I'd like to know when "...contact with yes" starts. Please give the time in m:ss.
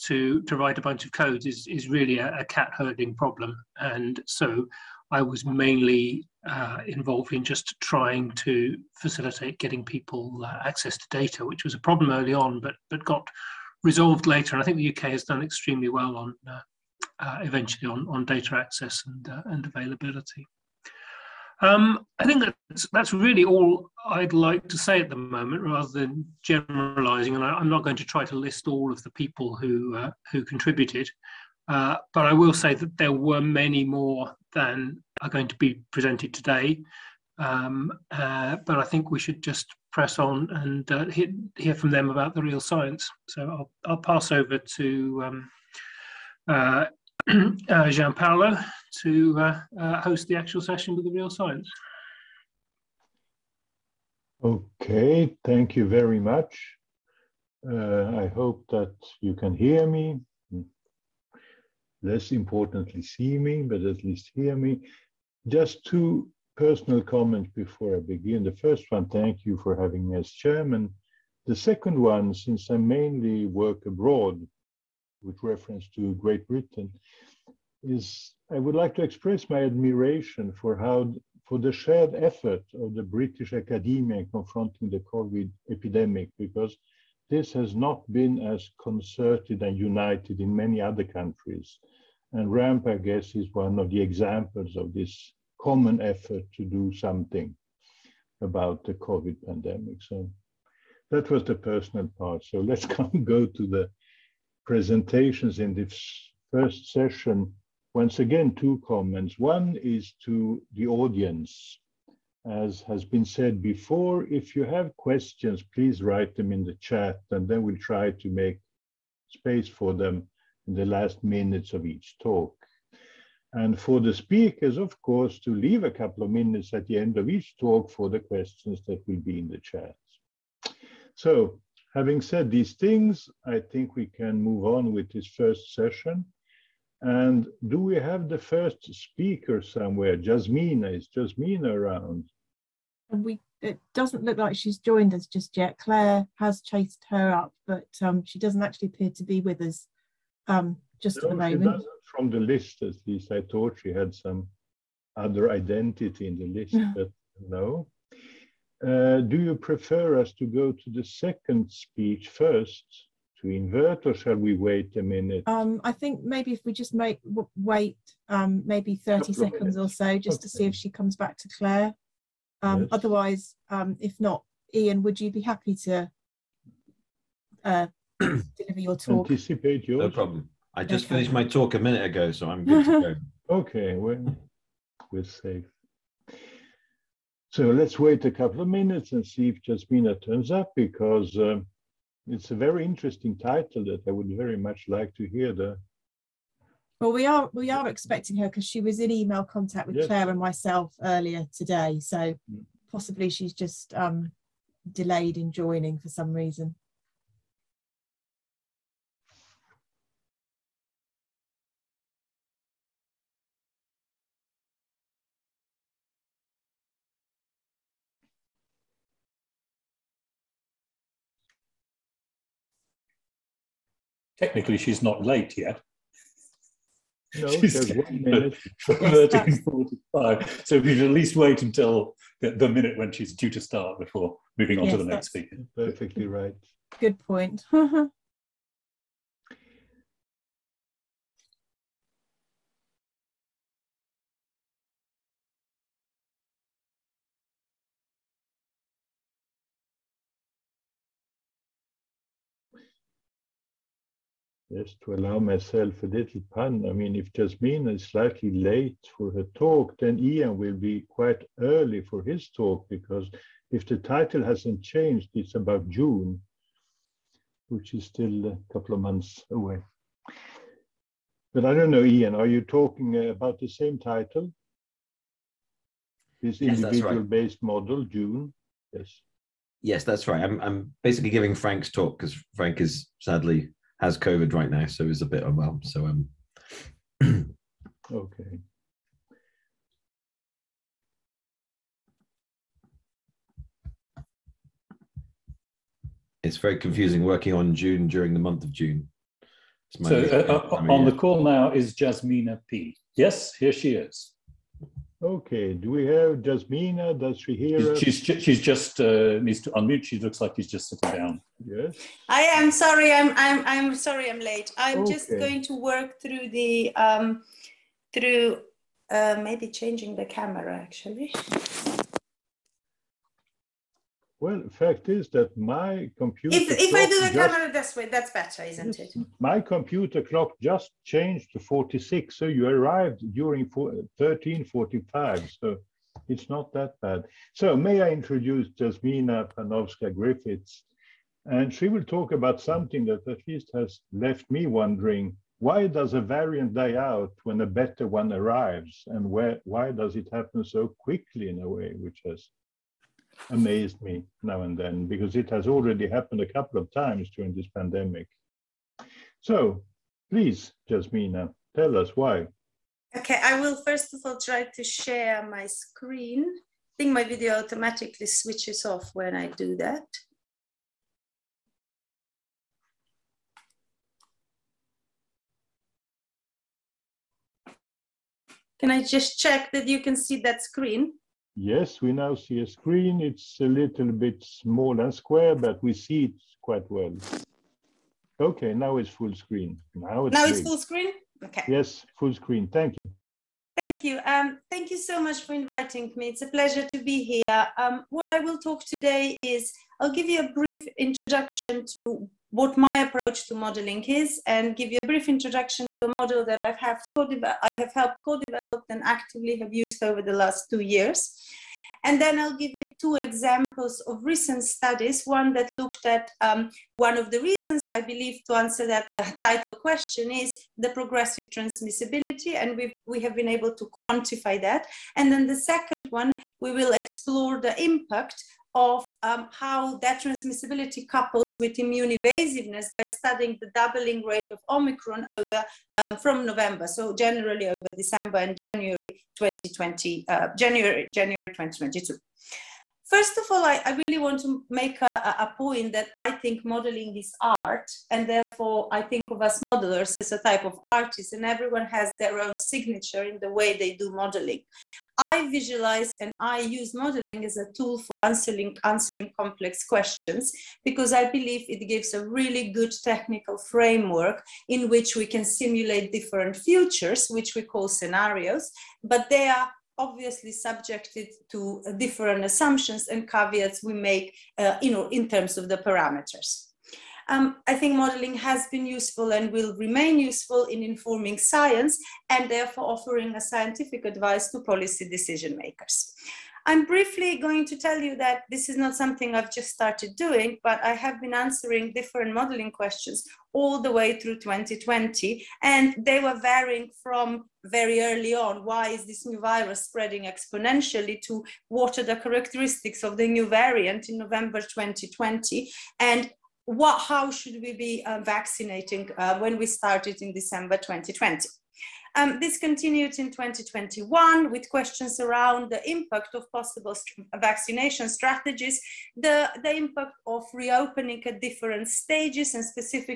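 3:19.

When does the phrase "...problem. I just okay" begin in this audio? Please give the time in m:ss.
3:00.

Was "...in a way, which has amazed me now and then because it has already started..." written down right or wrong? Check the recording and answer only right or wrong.
wrong.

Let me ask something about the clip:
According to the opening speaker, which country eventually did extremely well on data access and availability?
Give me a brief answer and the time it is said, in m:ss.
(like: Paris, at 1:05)
UK, at 0:14.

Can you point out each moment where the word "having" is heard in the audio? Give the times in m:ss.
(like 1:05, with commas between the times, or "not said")
1:09, 2:11.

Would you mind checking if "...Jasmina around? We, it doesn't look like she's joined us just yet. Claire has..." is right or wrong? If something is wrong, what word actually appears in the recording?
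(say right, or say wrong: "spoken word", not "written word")
right.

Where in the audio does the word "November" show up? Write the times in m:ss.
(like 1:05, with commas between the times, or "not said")
7:16, 8:24.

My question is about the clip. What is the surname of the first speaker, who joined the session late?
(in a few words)
Panovska Griffiths.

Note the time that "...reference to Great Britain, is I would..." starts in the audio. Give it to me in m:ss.
1:15.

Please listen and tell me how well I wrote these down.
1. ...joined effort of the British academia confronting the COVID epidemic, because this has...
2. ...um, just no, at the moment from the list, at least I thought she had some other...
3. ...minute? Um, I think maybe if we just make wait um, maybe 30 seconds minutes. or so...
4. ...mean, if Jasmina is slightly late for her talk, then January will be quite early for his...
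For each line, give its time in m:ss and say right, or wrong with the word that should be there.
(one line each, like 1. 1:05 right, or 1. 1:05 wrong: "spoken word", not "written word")
1. 1:21 wrong: "shared", not "joined"
2. 2:30 right
3. 2:45 right
4. 4:16 wrong: "Ian", not "January".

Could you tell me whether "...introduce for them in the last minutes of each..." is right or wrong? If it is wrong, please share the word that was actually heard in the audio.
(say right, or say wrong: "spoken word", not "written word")
wrong: "space", not "introduce".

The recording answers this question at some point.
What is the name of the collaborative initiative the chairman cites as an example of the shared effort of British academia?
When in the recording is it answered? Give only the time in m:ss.
1:32.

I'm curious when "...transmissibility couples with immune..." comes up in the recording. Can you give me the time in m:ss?
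7:10.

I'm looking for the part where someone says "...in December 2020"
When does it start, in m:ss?
8:30.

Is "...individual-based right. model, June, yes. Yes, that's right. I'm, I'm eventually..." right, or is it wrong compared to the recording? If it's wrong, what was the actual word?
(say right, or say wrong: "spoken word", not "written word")
wrong: "basically", not "eventually".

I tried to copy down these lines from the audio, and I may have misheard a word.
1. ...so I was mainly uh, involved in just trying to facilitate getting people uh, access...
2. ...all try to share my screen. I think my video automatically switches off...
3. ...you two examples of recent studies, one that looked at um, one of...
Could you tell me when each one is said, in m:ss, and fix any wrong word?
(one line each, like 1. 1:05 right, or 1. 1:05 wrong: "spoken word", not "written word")
1. 0:04 right
2. 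6:04 right
3. 6:52 right.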